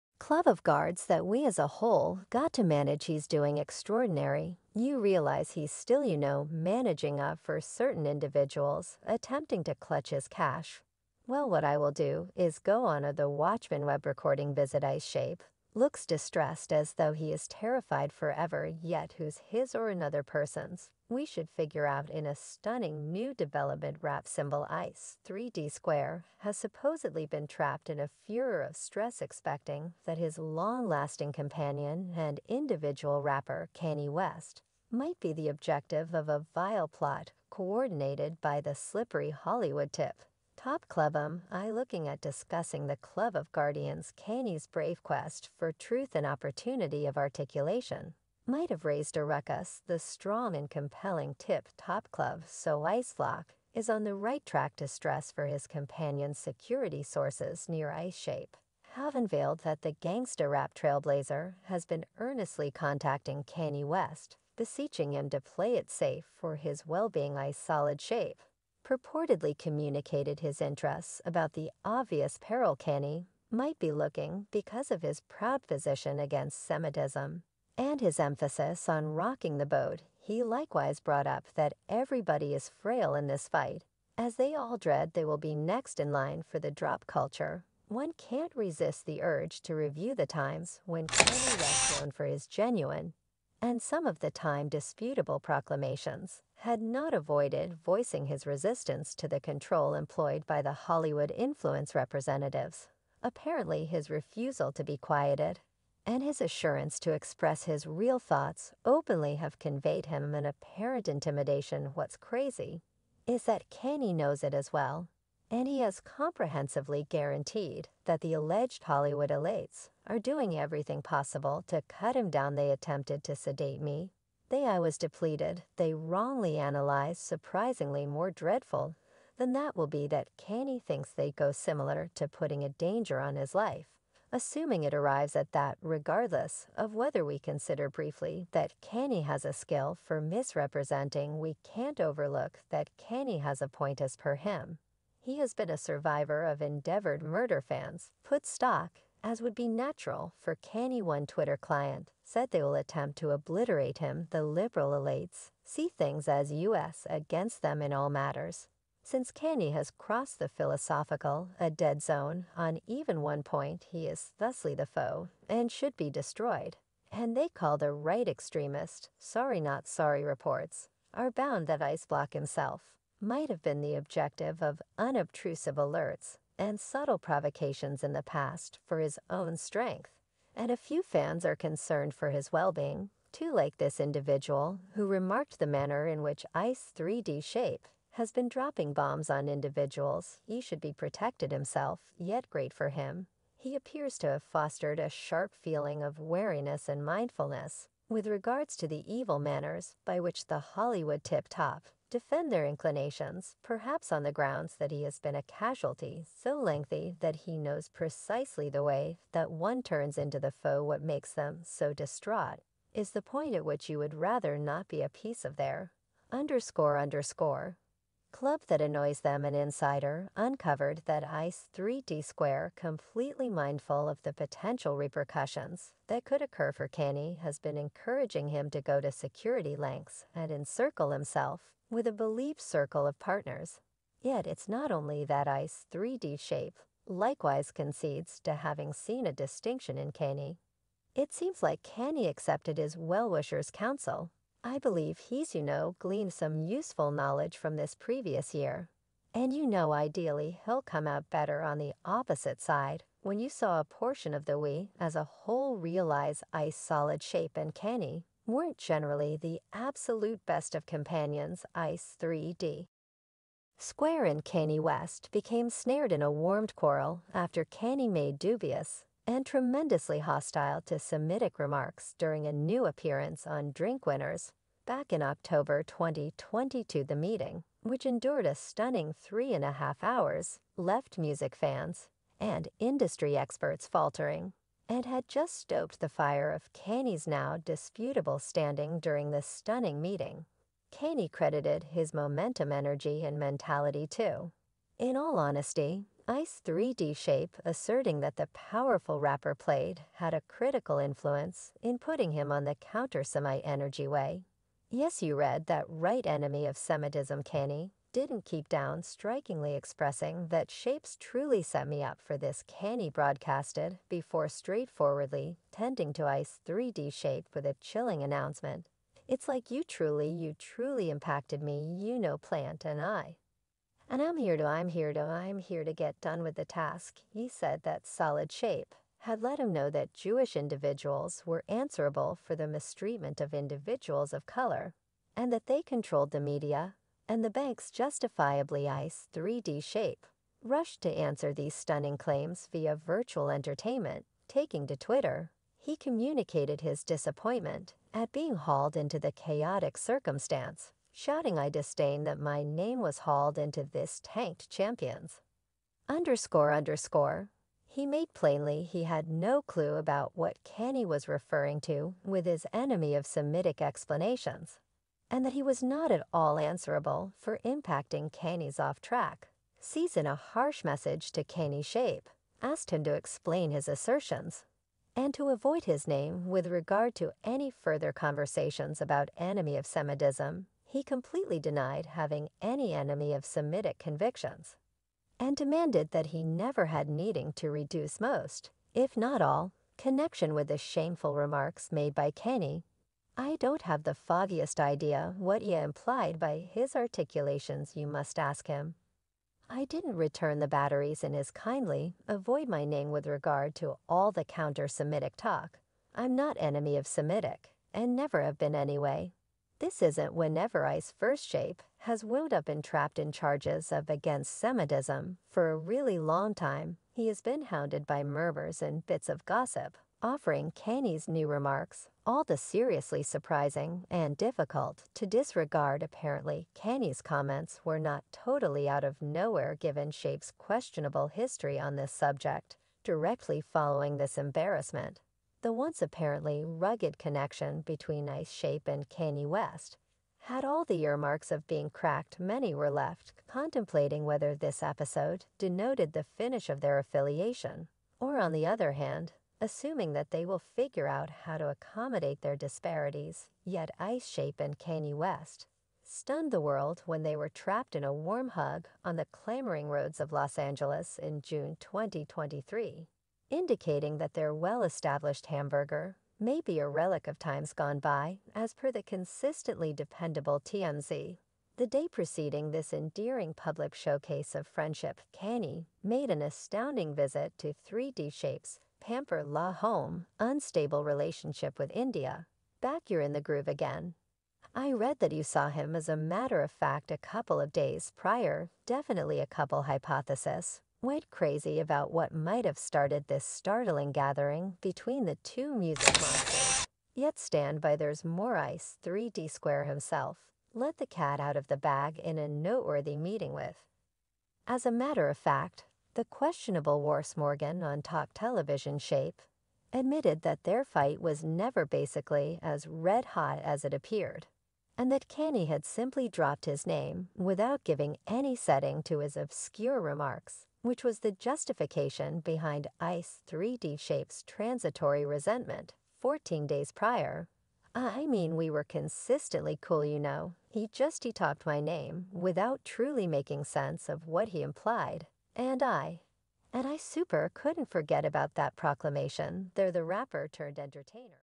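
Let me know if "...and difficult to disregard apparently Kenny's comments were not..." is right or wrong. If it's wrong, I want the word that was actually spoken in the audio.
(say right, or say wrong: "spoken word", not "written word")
right.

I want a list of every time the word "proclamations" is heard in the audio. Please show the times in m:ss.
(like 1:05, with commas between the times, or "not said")
1:35, 8:58.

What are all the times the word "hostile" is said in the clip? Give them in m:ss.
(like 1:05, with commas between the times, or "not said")
4:30.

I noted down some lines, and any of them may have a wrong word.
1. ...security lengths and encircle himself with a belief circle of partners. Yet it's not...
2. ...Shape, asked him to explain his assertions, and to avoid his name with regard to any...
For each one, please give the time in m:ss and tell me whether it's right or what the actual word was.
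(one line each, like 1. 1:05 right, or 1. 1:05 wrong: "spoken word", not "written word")
1. 3:49 right
2. 6:11 right.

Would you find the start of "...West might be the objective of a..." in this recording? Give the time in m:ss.
0:34.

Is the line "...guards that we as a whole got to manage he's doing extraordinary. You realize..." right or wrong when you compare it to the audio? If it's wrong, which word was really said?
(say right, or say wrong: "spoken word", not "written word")
right.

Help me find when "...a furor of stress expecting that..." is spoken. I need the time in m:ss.
0:27.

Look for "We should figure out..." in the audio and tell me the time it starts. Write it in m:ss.
0:21.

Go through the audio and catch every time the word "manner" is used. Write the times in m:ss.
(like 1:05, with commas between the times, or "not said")
3:05, 3:19.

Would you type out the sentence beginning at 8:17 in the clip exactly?
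Yet stand by there's more ice 3D Square himself let the cat out of the bag in a noteworthy meeting with.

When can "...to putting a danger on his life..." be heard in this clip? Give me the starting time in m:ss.
2:12.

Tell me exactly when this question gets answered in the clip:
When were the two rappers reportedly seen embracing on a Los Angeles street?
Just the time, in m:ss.
7:41.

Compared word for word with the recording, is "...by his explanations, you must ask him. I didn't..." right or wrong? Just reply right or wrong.
wrong.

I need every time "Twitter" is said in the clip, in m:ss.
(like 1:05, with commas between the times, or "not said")
2:31, 5:44.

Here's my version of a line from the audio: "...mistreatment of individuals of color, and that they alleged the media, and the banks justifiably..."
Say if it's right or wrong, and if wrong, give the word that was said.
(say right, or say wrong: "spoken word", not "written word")
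wrong: "controlled", not "alleged".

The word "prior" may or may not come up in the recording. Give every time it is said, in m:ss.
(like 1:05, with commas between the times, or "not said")
8:08, 8:46.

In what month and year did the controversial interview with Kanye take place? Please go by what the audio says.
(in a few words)
October 2022.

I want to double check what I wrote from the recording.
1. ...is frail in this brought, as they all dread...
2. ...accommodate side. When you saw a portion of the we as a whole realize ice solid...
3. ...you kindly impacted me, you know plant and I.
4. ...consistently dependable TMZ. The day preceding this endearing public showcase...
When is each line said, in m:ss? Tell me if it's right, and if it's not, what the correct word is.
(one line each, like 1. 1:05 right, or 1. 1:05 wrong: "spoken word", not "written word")
1. 1:22 wrong: "fight", not "brought"
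2. 4:12 wrong: "opposite", not "accommodate"
3. 5:20 wrong: "truly", not "kindly"
4. 7:49 right.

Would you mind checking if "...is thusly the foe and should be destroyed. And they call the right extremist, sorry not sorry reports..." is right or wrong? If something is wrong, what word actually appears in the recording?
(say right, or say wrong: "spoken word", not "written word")
right.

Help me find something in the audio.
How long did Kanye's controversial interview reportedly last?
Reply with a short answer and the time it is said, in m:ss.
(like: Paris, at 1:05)
3.5 hours, at 4:39.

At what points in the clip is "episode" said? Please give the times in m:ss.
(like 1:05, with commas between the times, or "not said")
7:24.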